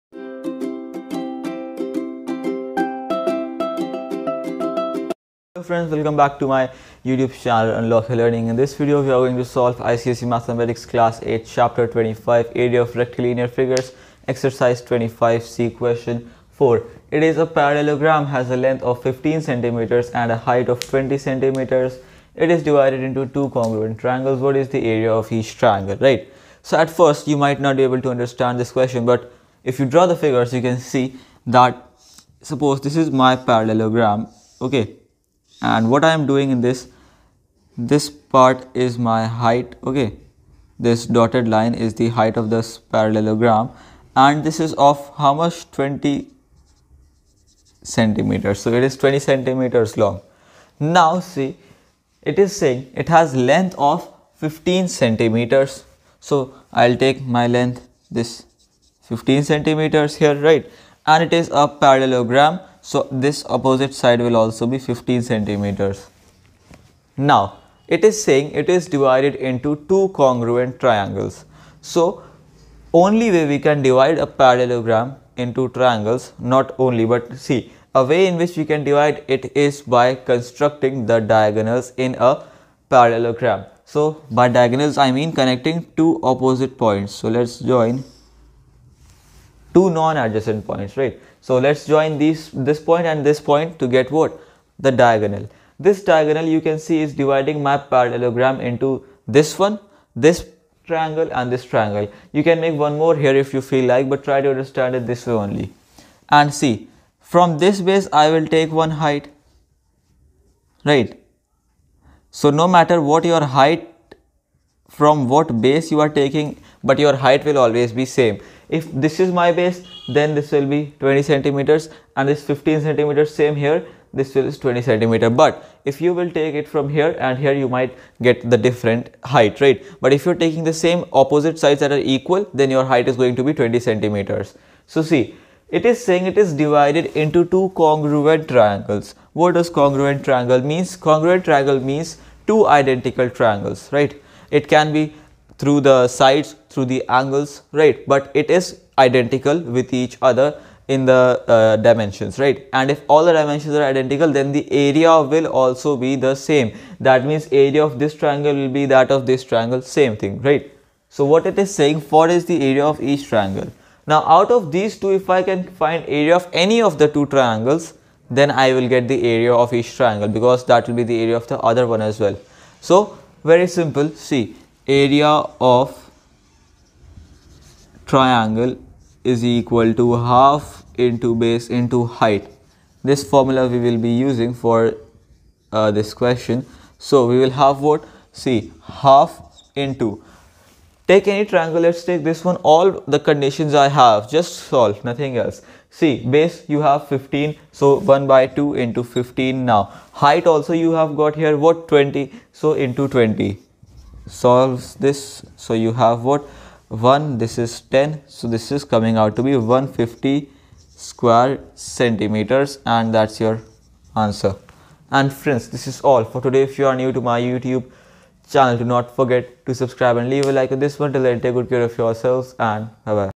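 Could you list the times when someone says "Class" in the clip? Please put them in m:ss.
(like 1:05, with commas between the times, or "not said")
0:10.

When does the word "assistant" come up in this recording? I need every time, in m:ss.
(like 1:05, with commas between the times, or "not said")
not said.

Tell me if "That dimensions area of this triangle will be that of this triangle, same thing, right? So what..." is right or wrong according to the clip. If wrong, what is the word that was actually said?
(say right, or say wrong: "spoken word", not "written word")
wrong: "means", not "dimensions".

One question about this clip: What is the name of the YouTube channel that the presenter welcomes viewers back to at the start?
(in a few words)
Unlock Learning.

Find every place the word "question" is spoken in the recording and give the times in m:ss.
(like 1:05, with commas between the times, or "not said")
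0:15, 0:28, 3:06.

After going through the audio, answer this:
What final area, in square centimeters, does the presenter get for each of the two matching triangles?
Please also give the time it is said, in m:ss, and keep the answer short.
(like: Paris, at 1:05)
150 square centimeters, at 3:29.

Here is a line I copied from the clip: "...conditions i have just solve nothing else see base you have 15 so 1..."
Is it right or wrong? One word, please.
right.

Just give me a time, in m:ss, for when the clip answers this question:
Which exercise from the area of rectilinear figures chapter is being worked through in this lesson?
0:14.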